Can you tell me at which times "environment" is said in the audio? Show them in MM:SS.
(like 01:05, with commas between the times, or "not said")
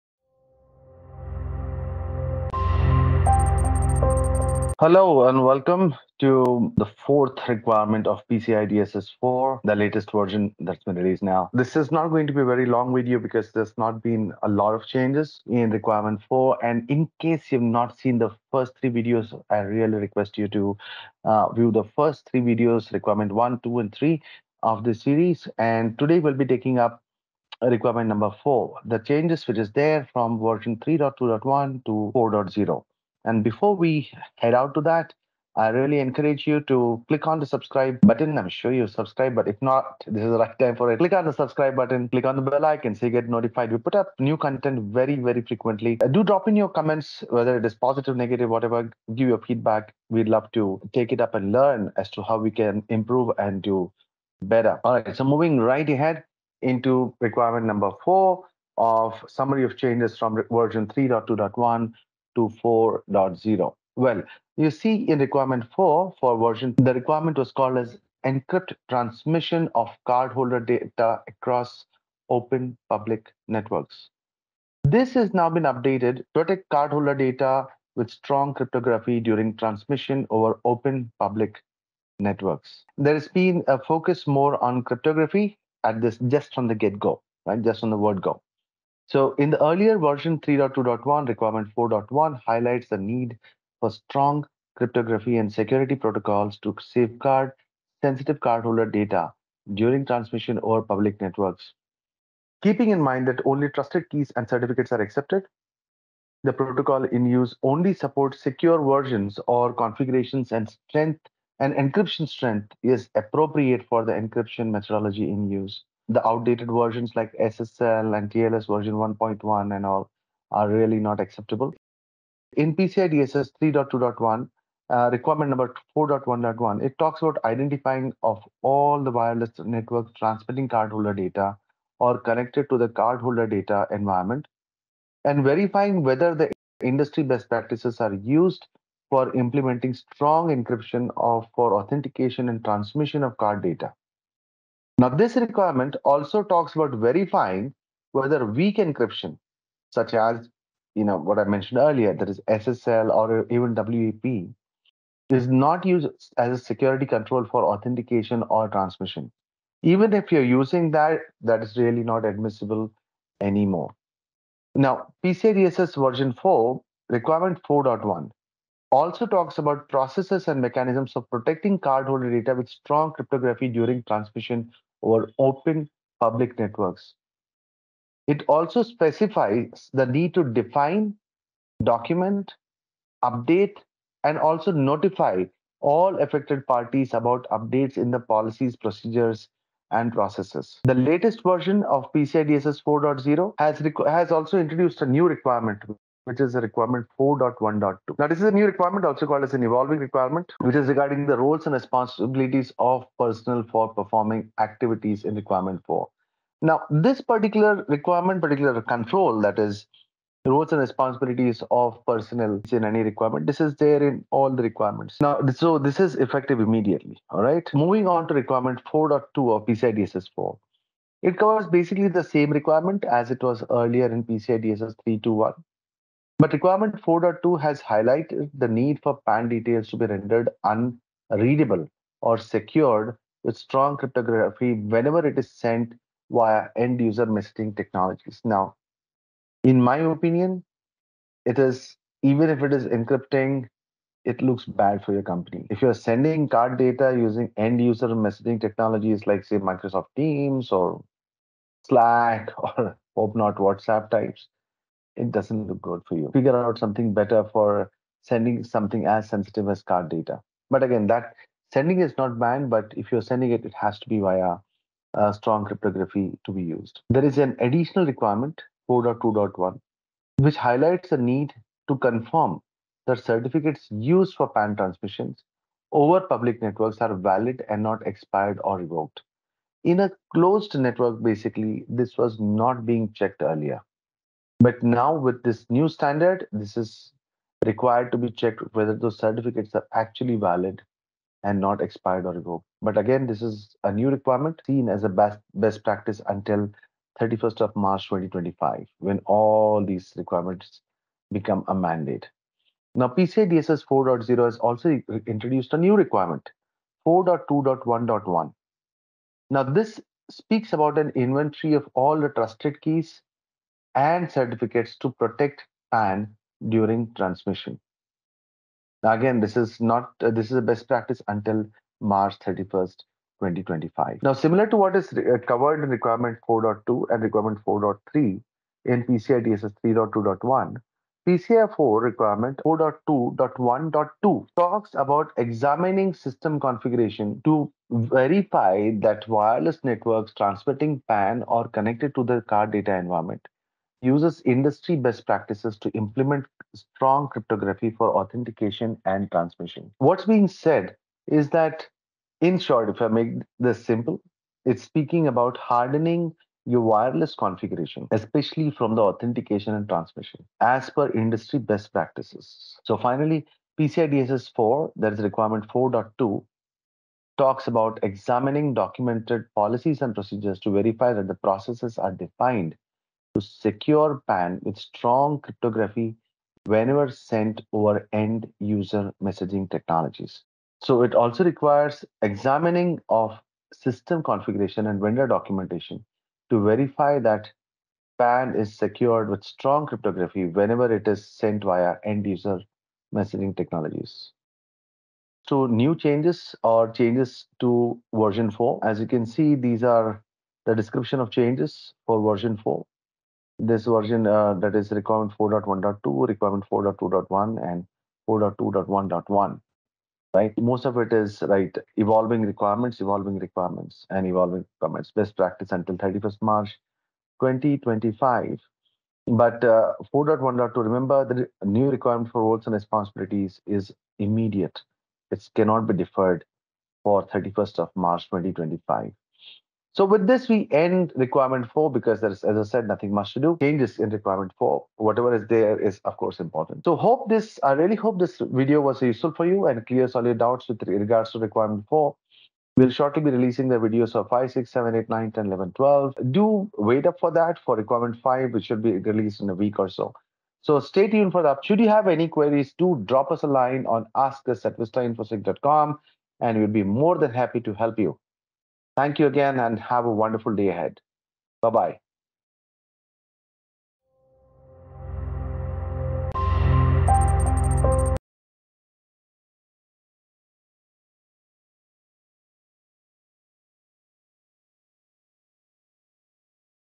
02:13, 05:42.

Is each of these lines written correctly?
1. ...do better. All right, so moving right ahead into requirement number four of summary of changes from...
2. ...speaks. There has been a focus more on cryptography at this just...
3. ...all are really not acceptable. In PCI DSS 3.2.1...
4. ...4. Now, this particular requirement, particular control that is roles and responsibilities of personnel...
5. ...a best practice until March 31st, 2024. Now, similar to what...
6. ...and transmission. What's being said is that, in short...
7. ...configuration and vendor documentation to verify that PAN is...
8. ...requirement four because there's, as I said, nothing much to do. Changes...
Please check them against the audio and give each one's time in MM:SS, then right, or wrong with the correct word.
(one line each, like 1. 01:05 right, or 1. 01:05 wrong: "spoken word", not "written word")
1. 00:53 right
2. 01:22 wrong: "networks", not "speaks"
3. 01:59 right
4. 03:25 right
5. 05:20 wrong: "2025", not "2024"
6. 05:49 right
7. 06:24 right
8. 07:11 right.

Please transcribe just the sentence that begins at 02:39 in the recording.
Even if you're using that, that is really not admissible anymore.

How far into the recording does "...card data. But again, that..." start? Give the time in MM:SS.
04:19.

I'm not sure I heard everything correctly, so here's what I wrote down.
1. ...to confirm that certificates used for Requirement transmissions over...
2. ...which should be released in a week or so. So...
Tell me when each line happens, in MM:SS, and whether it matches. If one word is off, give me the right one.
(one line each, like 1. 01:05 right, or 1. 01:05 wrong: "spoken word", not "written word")
1. 04:31 wrong: "PAN", not "Requirement"
2. 07:28 right.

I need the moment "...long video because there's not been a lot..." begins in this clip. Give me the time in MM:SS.
00:12.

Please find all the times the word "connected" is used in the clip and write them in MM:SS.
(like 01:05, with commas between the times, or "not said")
02:12, 05:41.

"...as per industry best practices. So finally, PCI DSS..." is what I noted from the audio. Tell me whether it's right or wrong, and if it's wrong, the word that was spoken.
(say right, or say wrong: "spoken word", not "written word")
right.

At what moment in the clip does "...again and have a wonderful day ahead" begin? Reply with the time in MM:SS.
07:39.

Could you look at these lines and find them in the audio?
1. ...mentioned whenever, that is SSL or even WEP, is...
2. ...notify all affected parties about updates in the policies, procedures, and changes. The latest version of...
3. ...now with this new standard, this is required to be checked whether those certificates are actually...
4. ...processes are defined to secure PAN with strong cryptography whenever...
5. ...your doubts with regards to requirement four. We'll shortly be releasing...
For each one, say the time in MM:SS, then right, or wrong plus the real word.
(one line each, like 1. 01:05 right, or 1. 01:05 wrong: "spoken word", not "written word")
1. 02:31 wrong: "earlier", not "whenever"
2. 03:04 wrong: "processes", not "changes"
3. 04:44 right
4. 06:11 right
5. 07:20 right.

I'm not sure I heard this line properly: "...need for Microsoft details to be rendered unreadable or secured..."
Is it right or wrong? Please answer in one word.
wrong.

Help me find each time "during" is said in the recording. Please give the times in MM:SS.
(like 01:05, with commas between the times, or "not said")
01:19, 01:39, 02:53, 05:16.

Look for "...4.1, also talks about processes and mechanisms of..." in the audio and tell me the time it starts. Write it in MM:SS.
02:47.